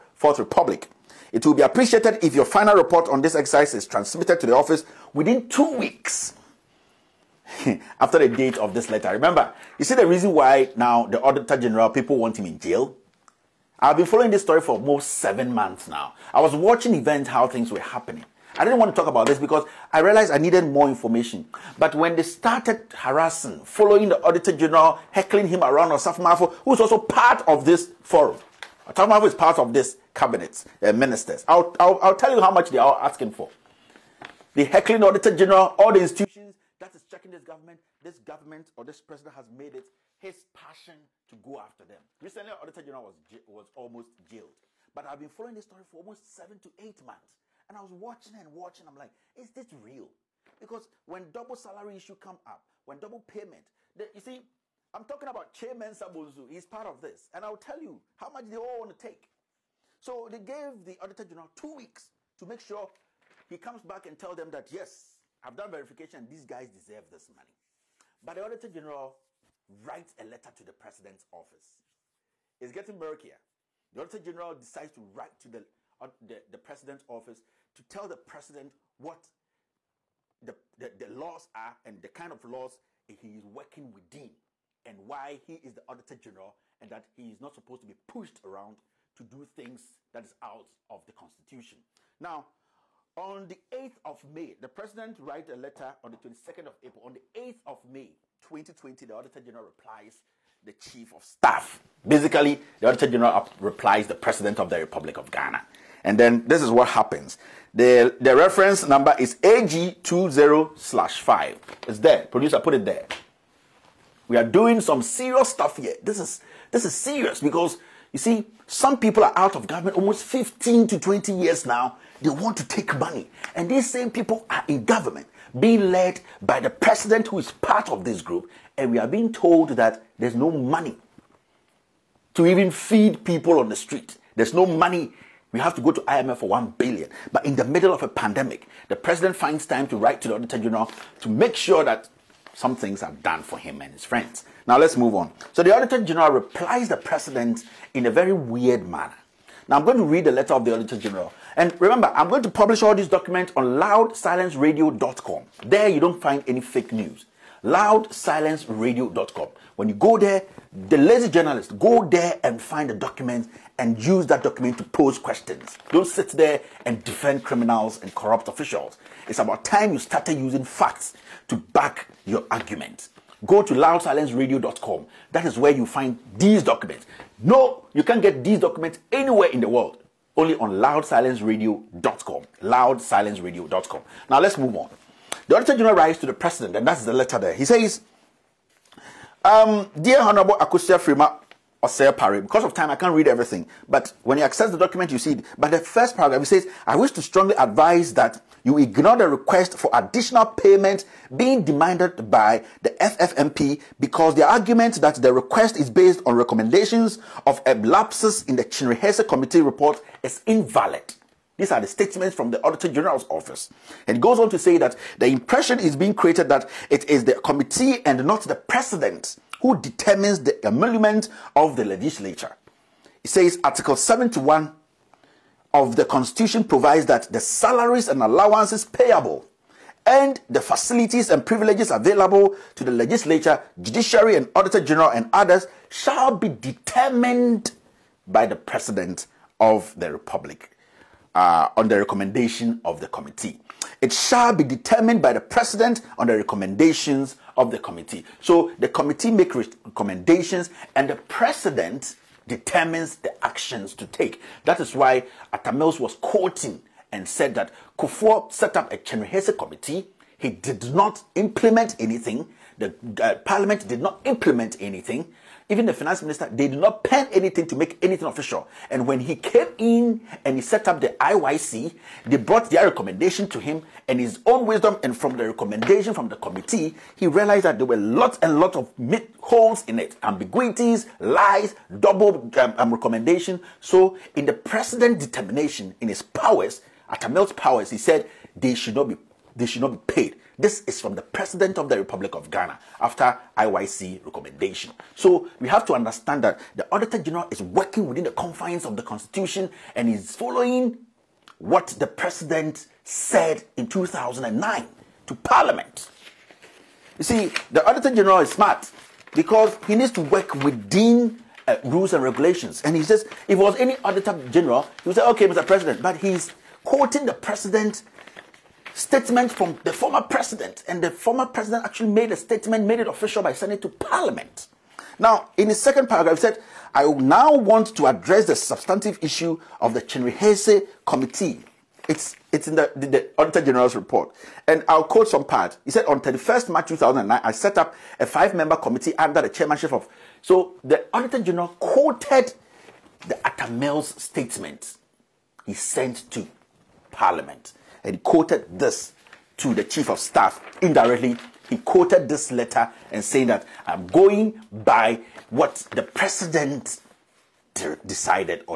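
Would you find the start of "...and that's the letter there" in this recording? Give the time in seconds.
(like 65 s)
186 s.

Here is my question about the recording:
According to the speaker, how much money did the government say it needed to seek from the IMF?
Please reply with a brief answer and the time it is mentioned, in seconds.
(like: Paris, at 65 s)
1 billion, at 136 s.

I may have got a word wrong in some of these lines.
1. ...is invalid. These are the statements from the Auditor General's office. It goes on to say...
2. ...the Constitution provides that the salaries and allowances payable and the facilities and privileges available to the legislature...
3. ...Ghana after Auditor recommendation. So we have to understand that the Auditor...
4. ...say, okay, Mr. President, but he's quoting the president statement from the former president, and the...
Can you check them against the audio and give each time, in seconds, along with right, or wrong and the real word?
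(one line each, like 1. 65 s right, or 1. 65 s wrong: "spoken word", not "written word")
1. 210 s right
2. 225 s right
3. 292 s wrong: "IYC", not "Auditor"
4. 315 s right.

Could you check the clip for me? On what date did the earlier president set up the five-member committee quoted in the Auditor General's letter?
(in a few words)
31 March 2009.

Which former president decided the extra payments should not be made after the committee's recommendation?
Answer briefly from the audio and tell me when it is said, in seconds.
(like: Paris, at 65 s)
Atta Mills, at 255 s.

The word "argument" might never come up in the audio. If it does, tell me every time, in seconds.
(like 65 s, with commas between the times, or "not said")
172 s, 204 s.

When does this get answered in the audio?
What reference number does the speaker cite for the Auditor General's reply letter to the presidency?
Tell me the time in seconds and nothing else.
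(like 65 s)
109 s.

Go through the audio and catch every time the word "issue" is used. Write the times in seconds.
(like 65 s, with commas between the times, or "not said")
51 s, 329 s.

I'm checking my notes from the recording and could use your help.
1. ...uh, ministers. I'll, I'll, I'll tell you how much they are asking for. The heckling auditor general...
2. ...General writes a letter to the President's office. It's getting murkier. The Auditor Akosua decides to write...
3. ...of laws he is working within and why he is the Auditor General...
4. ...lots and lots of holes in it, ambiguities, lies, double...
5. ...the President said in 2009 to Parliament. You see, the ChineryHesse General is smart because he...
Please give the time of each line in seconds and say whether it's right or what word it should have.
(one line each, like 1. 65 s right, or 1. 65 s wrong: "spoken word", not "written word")
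1. 30 s right
2. 68 s wrong: "General", not "Akosua"
3. 82 s right
4. 277 s right
5. 301 s wrong: "Auditor", not "ChineryHesse".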